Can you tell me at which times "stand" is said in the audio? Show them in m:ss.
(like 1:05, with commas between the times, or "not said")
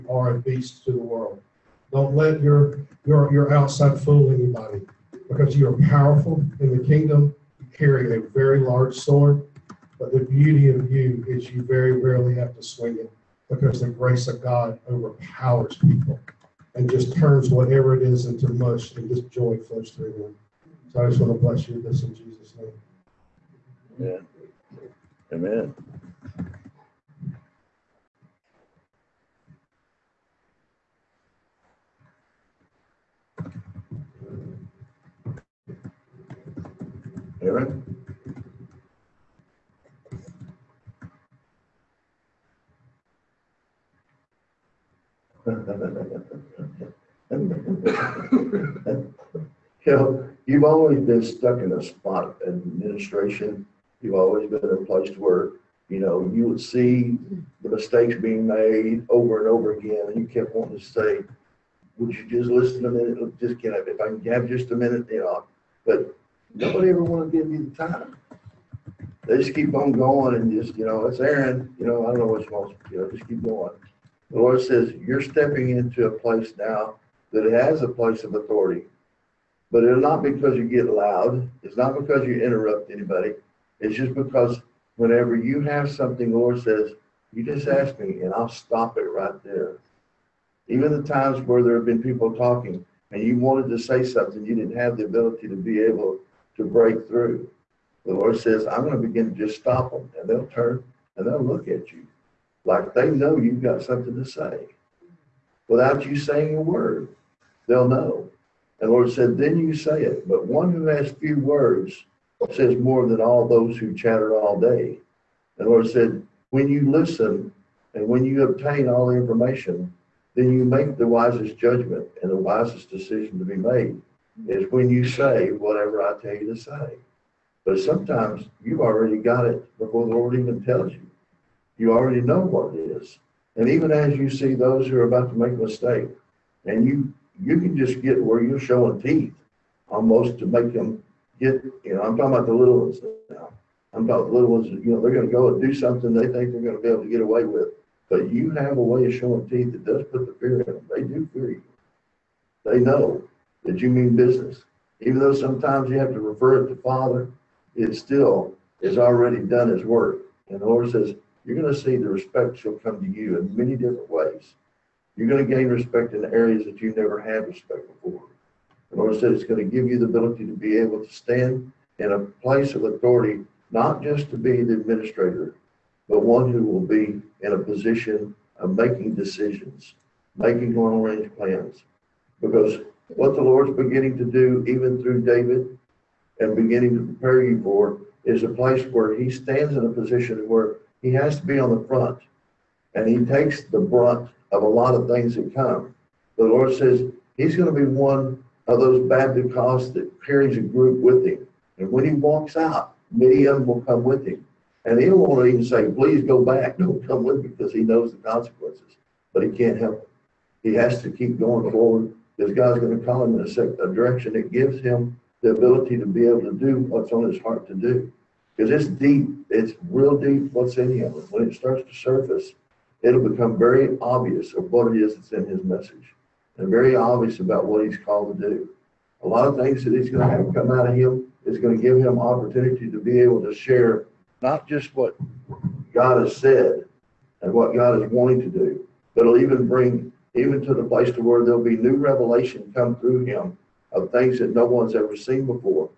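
2:51, 3:09.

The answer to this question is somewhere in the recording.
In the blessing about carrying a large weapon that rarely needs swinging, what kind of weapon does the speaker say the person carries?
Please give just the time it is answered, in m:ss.
0:08.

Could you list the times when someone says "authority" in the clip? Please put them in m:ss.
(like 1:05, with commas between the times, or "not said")
1:18, 2:52.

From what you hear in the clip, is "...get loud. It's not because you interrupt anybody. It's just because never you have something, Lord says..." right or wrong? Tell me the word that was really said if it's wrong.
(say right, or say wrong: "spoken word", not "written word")
wrong: "whenever", not "never".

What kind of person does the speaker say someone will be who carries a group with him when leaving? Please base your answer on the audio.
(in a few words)
Baptists.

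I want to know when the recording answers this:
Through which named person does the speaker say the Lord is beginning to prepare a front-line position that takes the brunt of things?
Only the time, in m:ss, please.
3:05.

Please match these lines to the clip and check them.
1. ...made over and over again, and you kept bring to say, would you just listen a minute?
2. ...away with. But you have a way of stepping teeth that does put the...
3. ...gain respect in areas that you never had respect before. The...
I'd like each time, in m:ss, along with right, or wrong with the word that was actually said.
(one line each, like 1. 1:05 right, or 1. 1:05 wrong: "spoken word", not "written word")
1. 0:58 wrong: "wanting", not "bring"
2. 2:27 wrong: "showing", not "stepping"
3. 2:45 right.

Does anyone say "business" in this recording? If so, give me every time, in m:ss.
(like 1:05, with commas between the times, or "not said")
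2:34.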